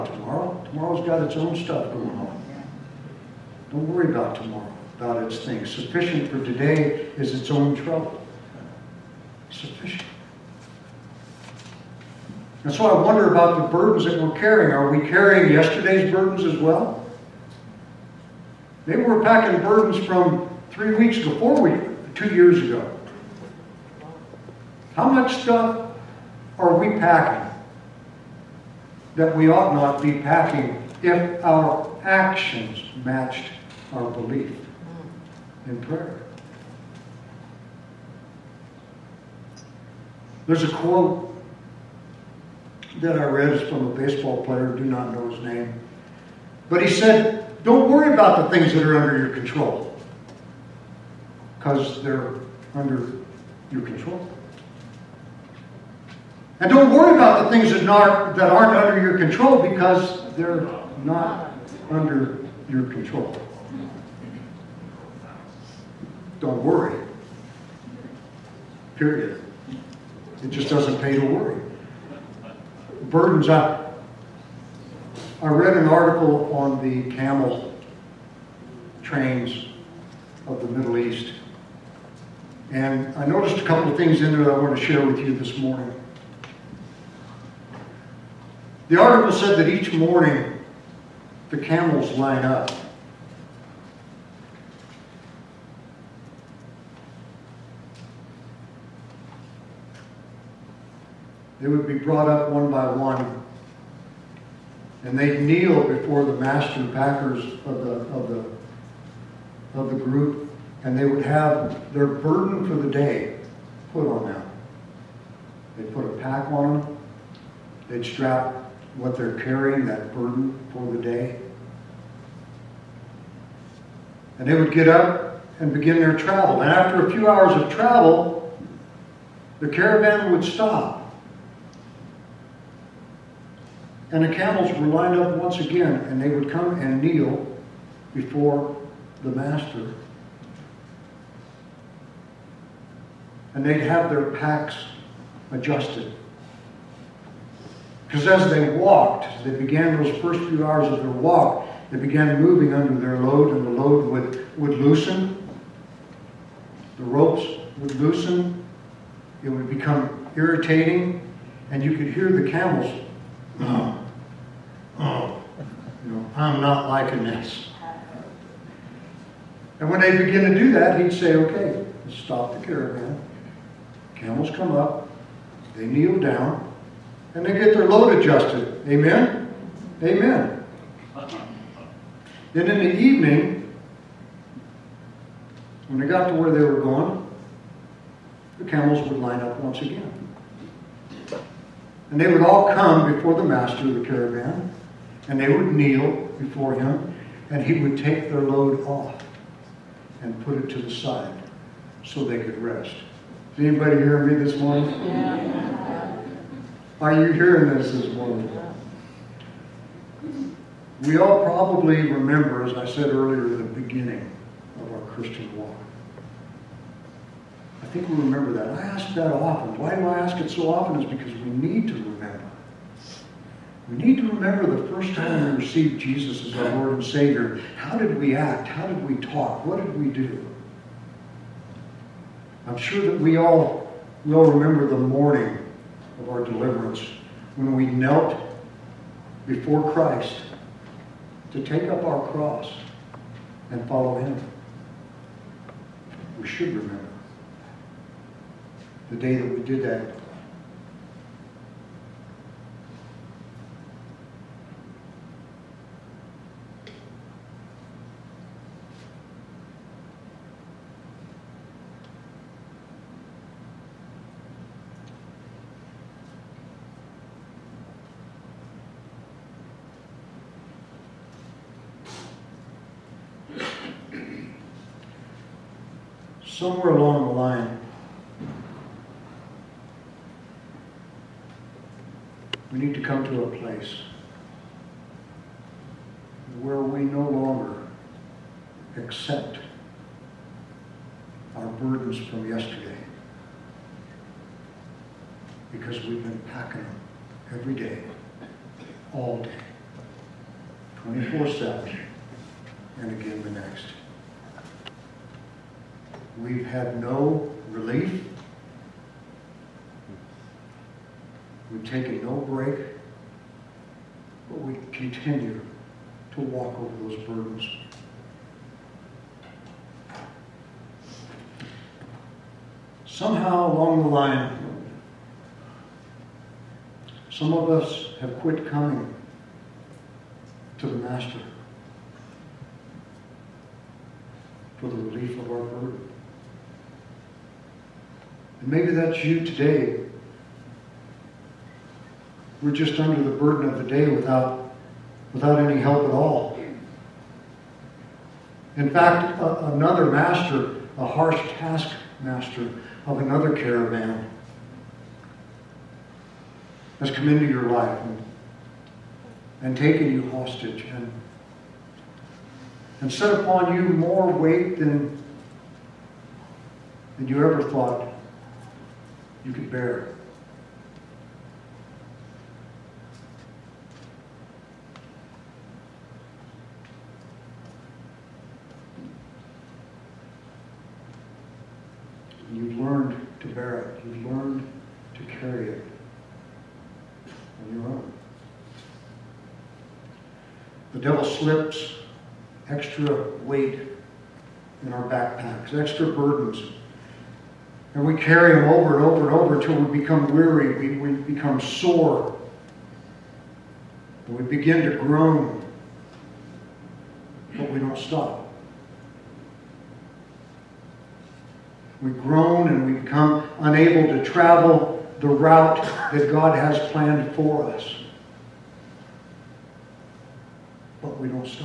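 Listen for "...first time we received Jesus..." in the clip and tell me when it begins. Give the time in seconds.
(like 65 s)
224 s.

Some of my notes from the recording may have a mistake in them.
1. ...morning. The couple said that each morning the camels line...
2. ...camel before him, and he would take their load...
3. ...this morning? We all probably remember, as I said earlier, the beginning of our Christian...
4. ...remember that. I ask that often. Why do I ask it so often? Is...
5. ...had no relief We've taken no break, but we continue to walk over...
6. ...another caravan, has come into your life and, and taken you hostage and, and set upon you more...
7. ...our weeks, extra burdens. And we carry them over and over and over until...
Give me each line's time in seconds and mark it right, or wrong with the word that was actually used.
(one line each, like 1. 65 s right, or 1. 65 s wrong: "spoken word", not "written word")
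1. 85 s wrong: "article", not "couple"
2. 195 s wrong: "kneel", not "camel"
3. 207 s right
4. 218 s right
5. 306 s right
6. 353 s right
7. 394 s wrong: "backpacks", not "weeks".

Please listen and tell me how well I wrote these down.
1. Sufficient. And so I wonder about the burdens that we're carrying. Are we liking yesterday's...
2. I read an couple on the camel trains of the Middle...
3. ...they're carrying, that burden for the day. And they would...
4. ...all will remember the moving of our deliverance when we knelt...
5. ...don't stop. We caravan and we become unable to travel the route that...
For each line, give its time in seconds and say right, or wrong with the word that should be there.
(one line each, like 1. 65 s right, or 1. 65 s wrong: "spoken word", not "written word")
1. 9 s wrong: "carrying", not "liking"
2. 75 s wrong: "article", not "couple"
3. 119 s right
4. 233 s wrong: "morning", not "moving"
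5. 407 s wrong: "groan", not "caravan".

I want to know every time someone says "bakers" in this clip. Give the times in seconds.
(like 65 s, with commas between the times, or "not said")
not said.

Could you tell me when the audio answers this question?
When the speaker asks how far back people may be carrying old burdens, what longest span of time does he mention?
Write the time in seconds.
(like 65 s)
22 s.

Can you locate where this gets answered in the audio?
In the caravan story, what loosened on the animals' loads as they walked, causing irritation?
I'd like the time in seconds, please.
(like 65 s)
156 s.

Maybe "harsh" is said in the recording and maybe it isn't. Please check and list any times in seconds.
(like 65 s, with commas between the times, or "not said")
351 s.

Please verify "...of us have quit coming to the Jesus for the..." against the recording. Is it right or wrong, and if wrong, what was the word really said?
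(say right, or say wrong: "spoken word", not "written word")
wrong: "Master", not "Jesus".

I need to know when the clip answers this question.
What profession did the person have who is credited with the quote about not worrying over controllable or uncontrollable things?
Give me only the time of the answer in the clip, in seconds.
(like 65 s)
43 s.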